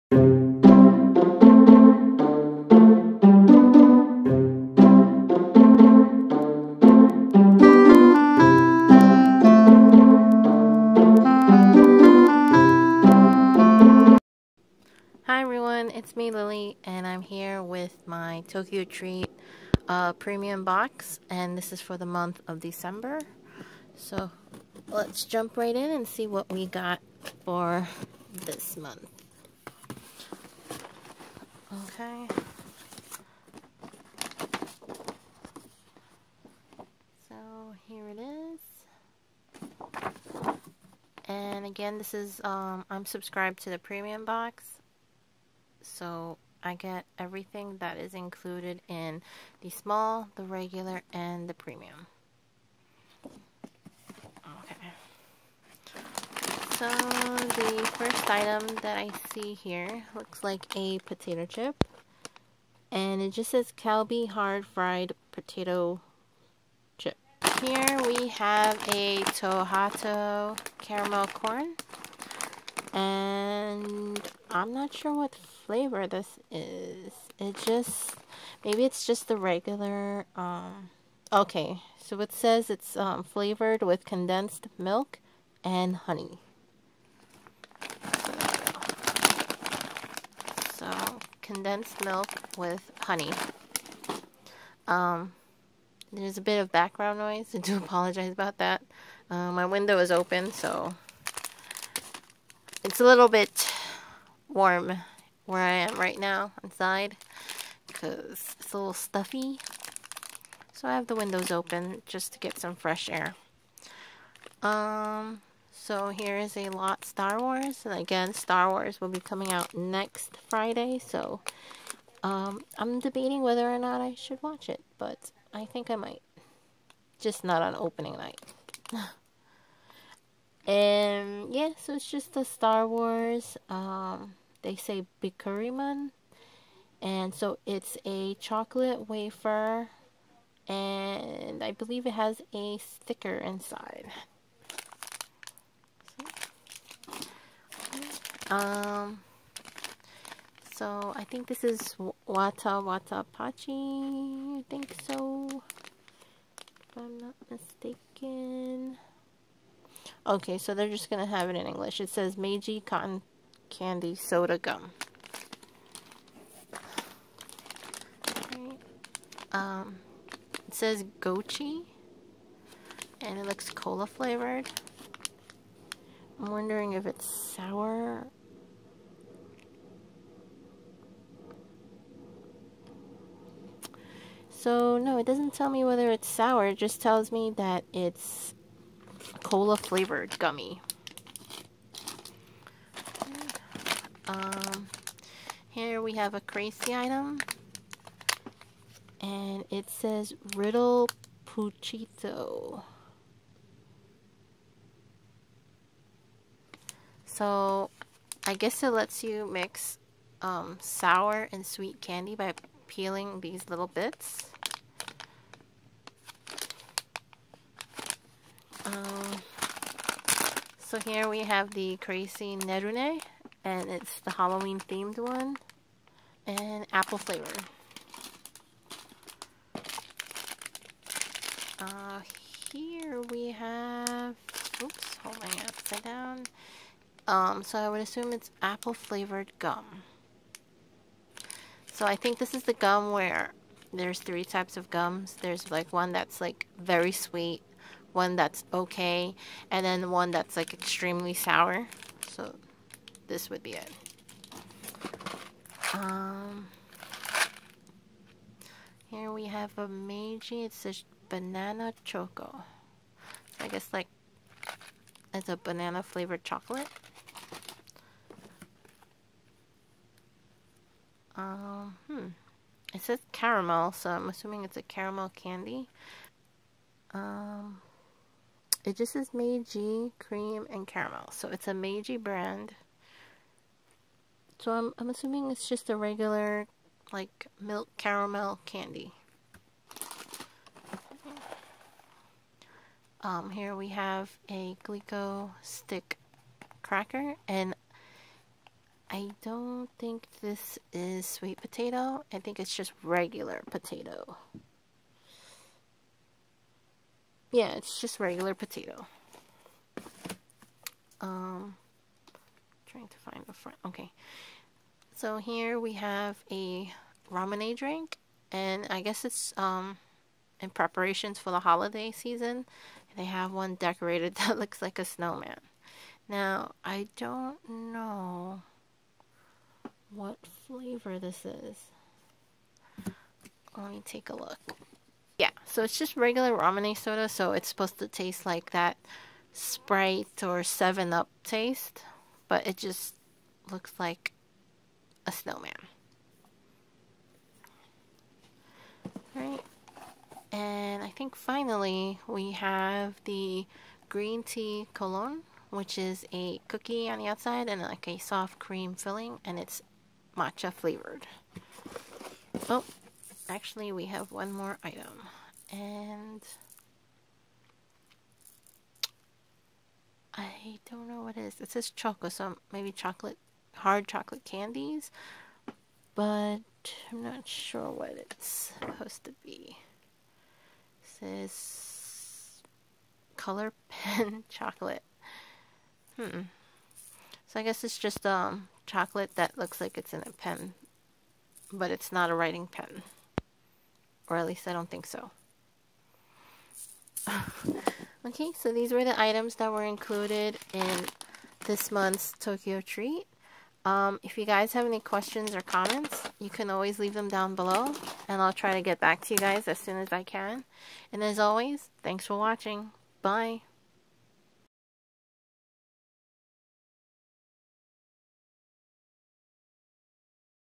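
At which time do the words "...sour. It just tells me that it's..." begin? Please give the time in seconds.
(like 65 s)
186 s.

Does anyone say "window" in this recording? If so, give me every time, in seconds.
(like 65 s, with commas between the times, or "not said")
99 s, 111 s.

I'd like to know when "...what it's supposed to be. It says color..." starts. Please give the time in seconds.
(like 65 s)
377 s.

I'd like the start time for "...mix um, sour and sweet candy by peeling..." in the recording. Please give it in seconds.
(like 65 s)
209 s.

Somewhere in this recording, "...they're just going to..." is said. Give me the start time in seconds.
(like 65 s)
160 s.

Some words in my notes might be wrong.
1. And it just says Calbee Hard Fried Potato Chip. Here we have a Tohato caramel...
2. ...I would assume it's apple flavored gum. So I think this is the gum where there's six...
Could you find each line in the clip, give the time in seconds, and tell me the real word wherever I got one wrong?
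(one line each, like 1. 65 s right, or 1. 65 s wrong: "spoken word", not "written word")
1. 62 s right
2. 237 s wrong: "three", not "six".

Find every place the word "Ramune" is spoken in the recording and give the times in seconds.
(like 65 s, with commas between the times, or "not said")
317 s, 336 s.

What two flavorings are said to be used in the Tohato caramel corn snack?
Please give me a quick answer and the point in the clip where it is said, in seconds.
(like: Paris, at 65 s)
condensed milk and honey, at 84 s.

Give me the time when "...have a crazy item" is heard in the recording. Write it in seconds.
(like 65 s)
196 s.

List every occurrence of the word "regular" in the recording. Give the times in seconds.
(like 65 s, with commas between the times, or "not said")
50 s, 79 s, 285 s, 303 s, 308 s, 336 s.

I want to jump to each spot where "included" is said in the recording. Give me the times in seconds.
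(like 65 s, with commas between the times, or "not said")
48 s, 399 s.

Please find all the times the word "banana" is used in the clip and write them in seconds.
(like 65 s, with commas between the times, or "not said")
261 s, 265 s.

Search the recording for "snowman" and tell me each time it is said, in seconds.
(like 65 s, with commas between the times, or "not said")
325 s, 345 s.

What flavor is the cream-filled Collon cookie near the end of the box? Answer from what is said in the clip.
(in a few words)
matcha.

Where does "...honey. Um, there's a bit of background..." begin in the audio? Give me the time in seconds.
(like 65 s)
93 s.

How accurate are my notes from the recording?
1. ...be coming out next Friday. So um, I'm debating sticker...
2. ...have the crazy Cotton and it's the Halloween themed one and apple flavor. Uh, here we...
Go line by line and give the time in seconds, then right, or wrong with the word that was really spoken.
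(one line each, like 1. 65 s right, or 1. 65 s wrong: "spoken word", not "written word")
1. 119 s wrong: "whether", not "sticker"
2. 221 s wrong: "Nerune", not "Cotton".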